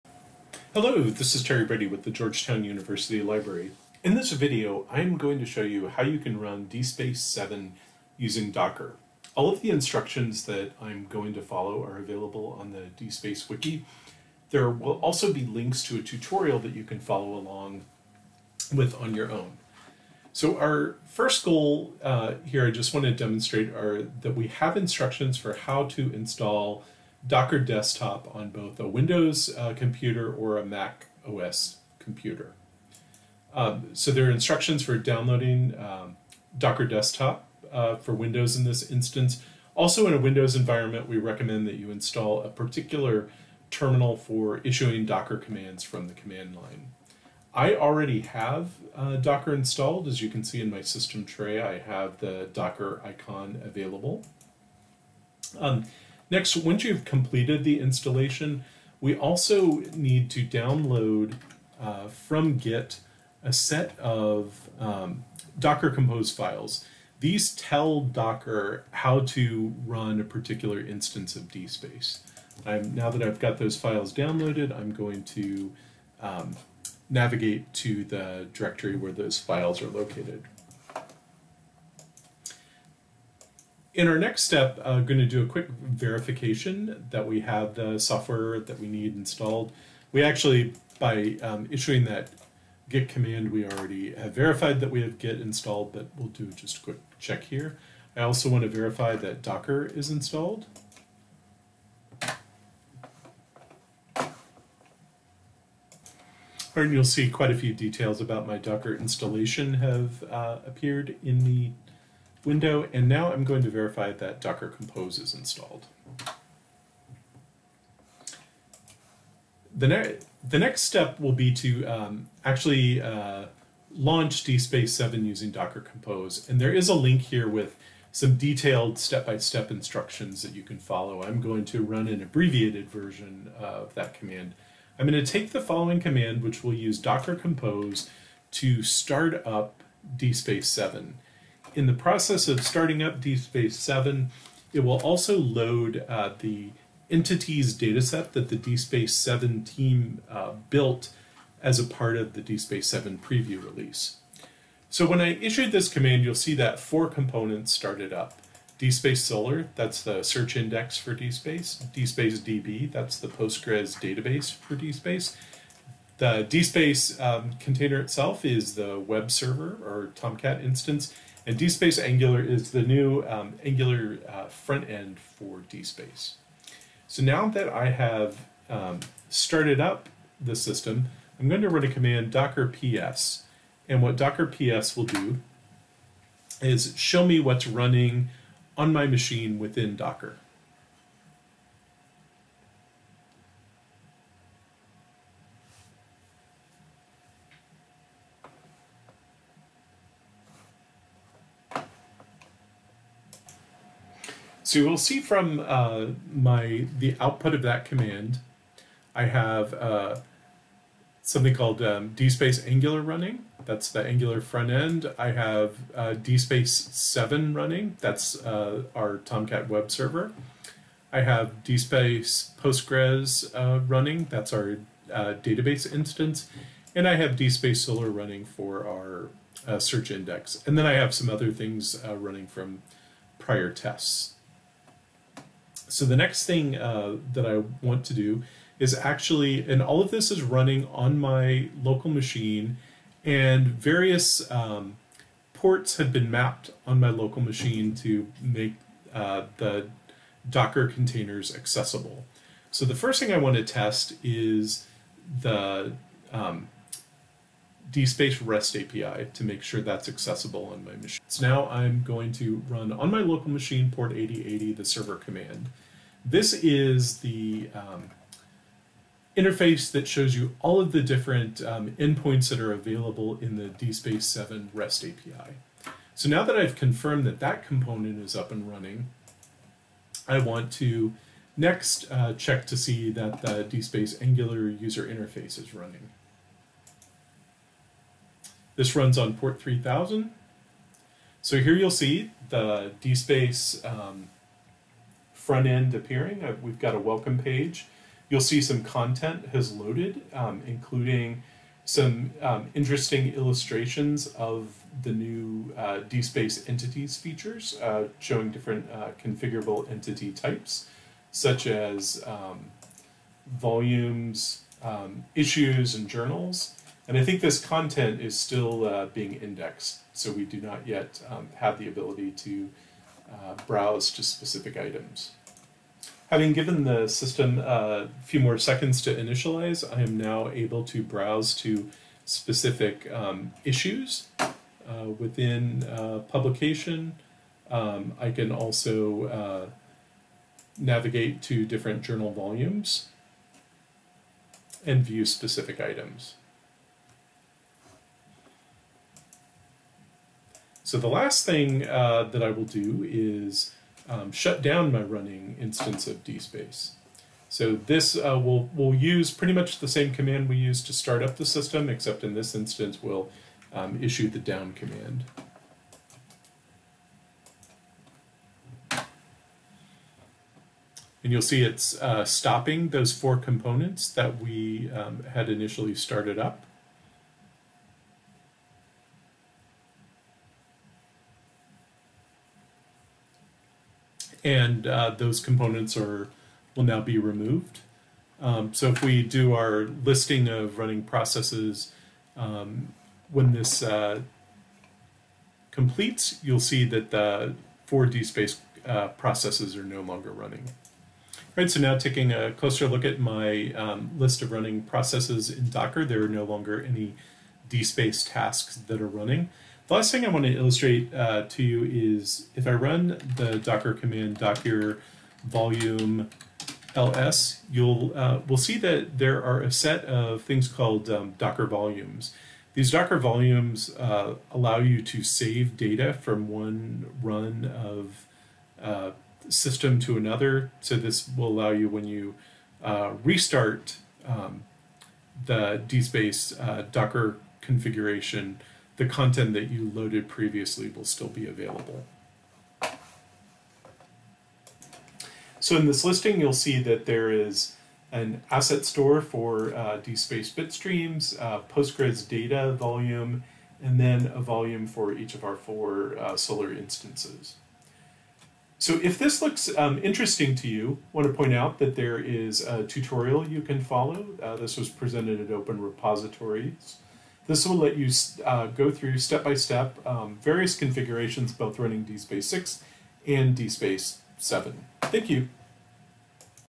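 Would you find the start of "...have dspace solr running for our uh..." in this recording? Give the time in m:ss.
3:47.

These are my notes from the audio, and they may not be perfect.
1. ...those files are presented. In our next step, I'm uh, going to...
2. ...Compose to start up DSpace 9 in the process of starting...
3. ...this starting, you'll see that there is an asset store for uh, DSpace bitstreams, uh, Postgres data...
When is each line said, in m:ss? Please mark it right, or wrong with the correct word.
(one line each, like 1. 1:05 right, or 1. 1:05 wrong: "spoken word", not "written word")
1. 1:19 wrong: "located", not "presented"
2. 2:17 wrong: "7", not "9"
3. 7:25 wrong: "listing", not "starting".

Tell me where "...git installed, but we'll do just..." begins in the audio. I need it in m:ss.
1:35.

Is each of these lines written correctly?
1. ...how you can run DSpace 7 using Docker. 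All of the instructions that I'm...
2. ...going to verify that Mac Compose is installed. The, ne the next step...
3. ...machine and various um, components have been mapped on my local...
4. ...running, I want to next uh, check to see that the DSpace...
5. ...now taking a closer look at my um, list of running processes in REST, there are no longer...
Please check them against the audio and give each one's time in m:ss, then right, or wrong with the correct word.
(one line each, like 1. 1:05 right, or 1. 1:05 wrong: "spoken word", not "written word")
1. 0:05 right
2. 1:53 wrong: "Docker", not "Mac"
3. 4:02 wrong: "ports", not "components"
4. 4:38 right
5. 6:41 wrong: "Docker", not "REST".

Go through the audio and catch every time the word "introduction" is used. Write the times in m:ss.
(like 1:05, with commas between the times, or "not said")
not said.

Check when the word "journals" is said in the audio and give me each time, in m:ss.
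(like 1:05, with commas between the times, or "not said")
5:16, 5:42.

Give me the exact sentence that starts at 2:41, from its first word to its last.
DSpace DB, that's the Postgres database for DSpace.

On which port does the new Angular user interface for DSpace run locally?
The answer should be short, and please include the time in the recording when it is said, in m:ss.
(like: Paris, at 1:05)
3000, at 4:49.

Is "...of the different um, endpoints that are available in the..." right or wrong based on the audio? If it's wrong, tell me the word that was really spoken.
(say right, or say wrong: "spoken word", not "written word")
right.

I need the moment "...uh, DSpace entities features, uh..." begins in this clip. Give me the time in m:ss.
5:05.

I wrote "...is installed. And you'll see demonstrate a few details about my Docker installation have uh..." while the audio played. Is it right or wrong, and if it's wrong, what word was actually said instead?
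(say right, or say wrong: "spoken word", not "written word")
wrong: "quite", not "demonstrate".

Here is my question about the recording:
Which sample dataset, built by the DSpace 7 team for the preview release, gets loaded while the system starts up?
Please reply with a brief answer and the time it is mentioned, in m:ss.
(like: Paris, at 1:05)
entities dataset, at 2:27.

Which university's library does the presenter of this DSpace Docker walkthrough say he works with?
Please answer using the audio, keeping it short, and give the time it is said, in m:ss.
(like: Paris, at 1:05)
Georgetown University, at 0:02.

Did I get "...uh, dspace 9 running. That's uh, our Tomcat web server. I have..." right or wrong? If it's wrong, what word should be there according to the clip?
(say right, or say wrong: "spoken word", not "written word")
wrong: "7", not "9".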